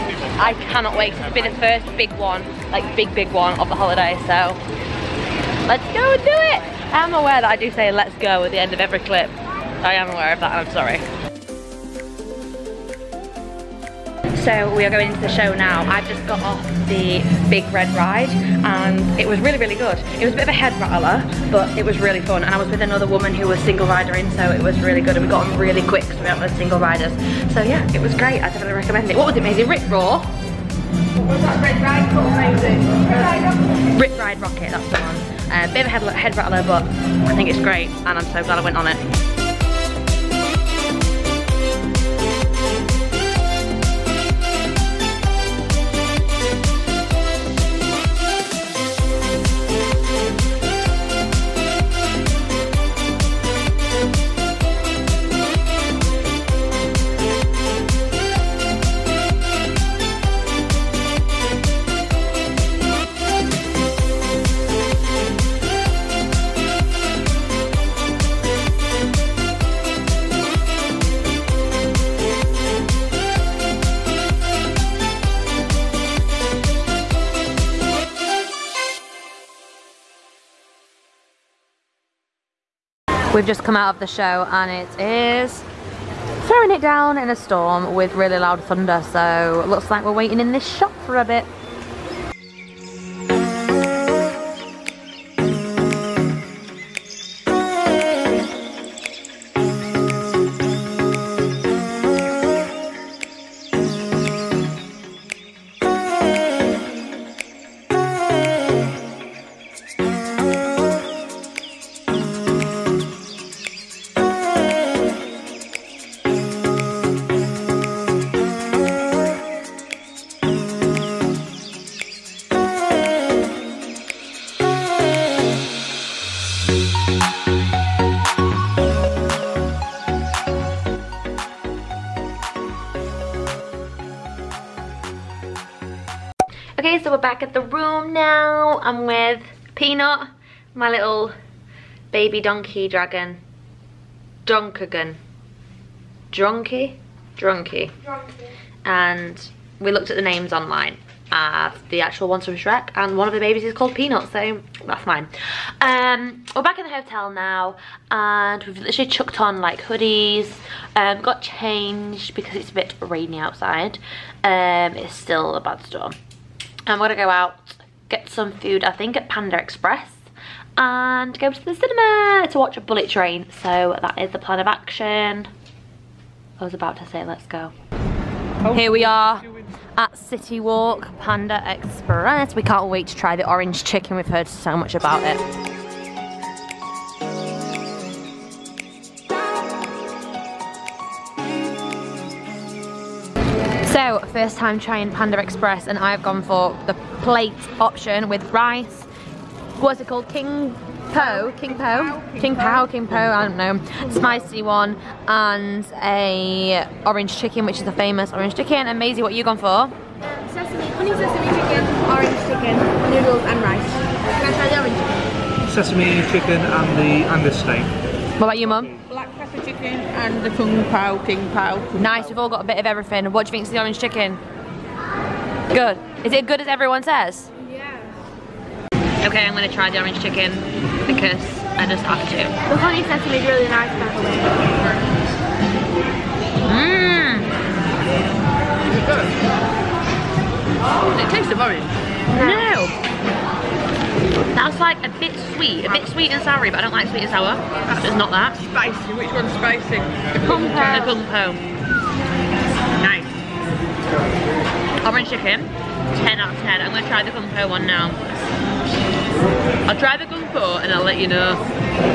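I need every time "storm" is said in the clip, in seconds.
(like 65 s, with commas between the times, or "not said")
87 s, 165 s.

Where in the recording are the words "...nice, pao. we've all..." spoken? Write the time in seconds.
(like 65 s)
222 s.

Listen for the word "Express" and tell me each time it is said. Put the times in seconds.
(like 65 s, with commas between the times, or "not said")
169 s, 181 s, 195 s.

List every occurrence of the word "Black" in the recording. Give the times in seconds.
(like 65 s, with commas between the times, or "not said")
219 s.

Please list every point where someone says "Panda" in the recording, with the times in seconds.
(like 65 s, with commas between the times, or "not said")
169 s, 181 s, 195 s.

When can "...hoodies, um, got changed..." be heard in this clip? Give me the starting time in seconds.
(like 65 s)
159 s.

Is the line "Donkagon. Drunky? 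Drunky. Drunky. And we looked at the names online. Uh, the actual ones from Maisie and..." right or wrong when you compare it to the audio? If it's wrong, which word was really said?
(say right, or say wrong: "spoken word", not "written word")
wrong: "Shrek", not "Maisie".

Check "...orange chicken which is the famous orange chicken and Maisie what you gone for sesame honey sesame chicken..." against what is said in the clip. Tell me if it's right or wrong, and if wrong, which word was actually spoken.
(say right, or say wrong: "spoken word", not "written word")
right.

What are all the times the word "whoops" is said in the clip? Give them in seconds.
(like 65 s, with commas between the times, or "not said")
not said.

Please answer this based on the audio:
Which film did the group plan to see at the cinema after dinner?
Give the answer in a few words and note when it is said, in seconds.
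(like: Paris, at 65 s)
Bullet Train, at 172 s.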